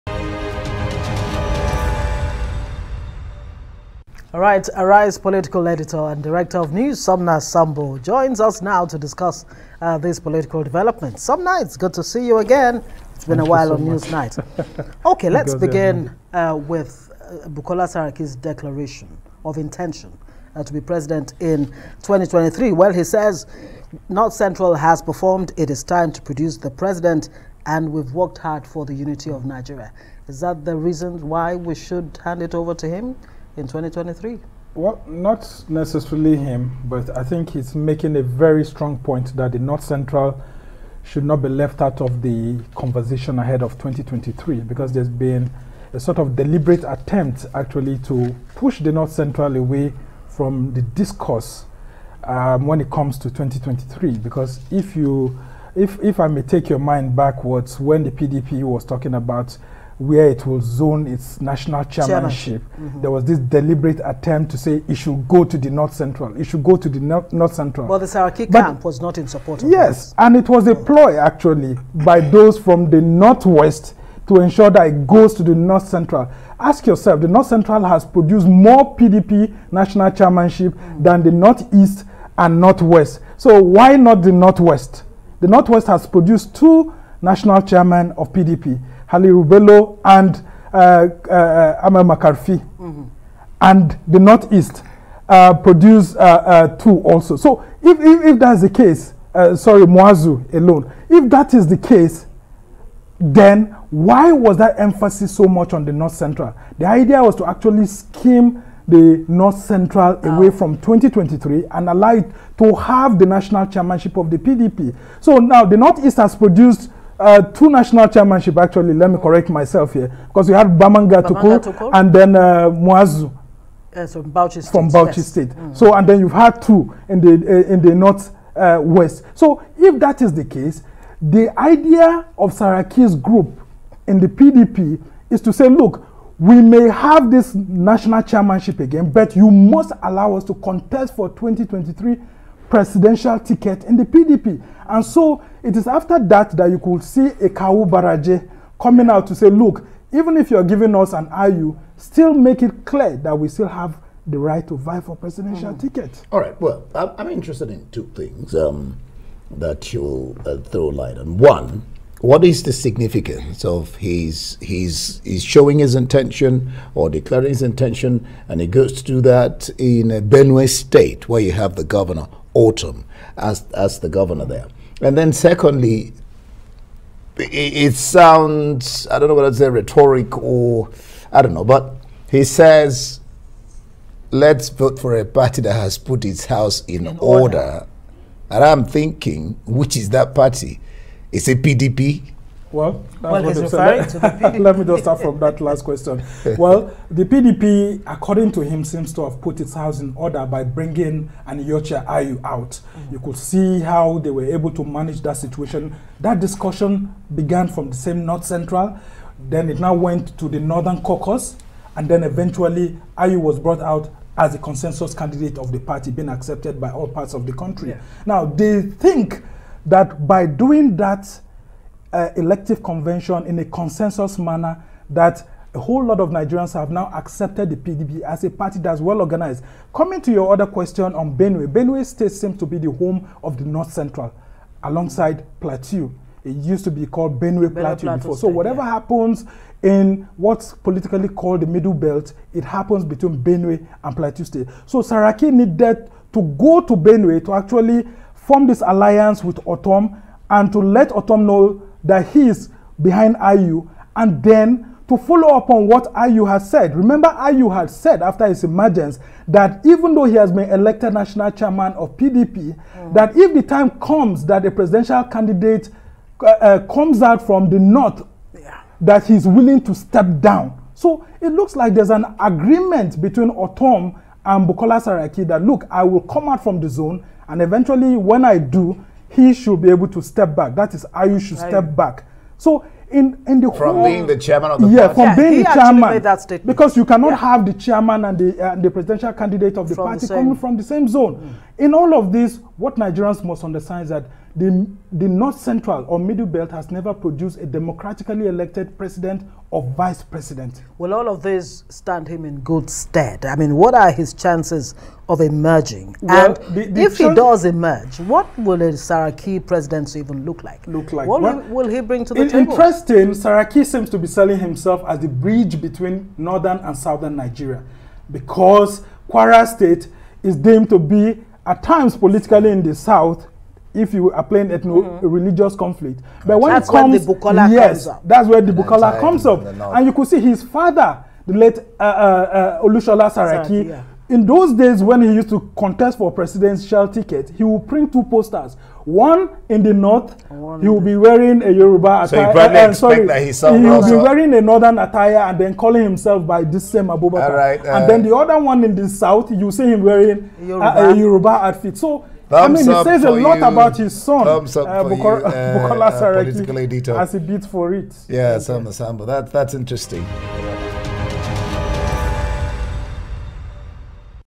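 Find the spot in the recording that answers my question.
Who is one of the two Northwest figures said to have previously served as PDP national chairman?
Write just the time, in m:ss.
1:32.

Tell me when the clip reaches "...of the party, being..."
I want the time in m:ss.
3:35.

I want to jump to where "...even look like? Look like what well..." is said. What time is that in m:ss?
5:10.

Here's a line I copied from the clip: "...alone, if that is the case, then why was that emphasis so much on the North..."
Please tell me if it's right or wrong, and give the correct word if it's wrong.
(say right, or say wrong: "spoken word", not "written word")
right.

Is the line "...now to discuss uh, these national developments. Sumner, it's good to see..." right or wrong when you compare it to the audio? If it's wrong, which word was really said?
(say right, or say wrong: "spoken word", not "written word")
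wrong: "political", not "national".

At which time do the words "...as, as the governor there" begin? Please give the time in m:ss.
2:53.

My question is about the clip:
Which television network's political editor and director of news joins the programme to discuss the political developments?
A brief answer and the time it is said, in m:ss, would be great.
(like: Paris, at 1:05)
Arise, at 0:04.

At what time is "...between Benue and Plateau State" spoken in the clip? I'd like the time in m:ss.
4:03.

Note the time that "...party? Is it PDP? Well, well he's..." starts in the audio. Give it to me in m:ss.
3:10.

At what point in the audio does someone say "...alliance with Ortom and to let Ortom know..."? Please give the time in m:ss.
4:08.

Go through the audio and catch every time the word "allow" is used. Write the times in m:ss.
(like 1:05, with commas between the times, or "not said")
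1:51, 2:20.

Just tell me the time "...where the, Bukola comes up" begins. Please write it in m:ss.
5:28.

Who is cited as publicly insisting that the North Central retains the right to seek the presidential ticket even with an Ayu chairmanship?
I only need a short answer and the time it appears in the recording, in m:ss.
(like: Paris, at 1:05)
Kawu Baraje, at 2:27.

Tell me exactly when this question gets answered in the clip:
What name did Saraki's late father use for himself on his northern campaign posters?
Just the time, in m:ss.
5:47.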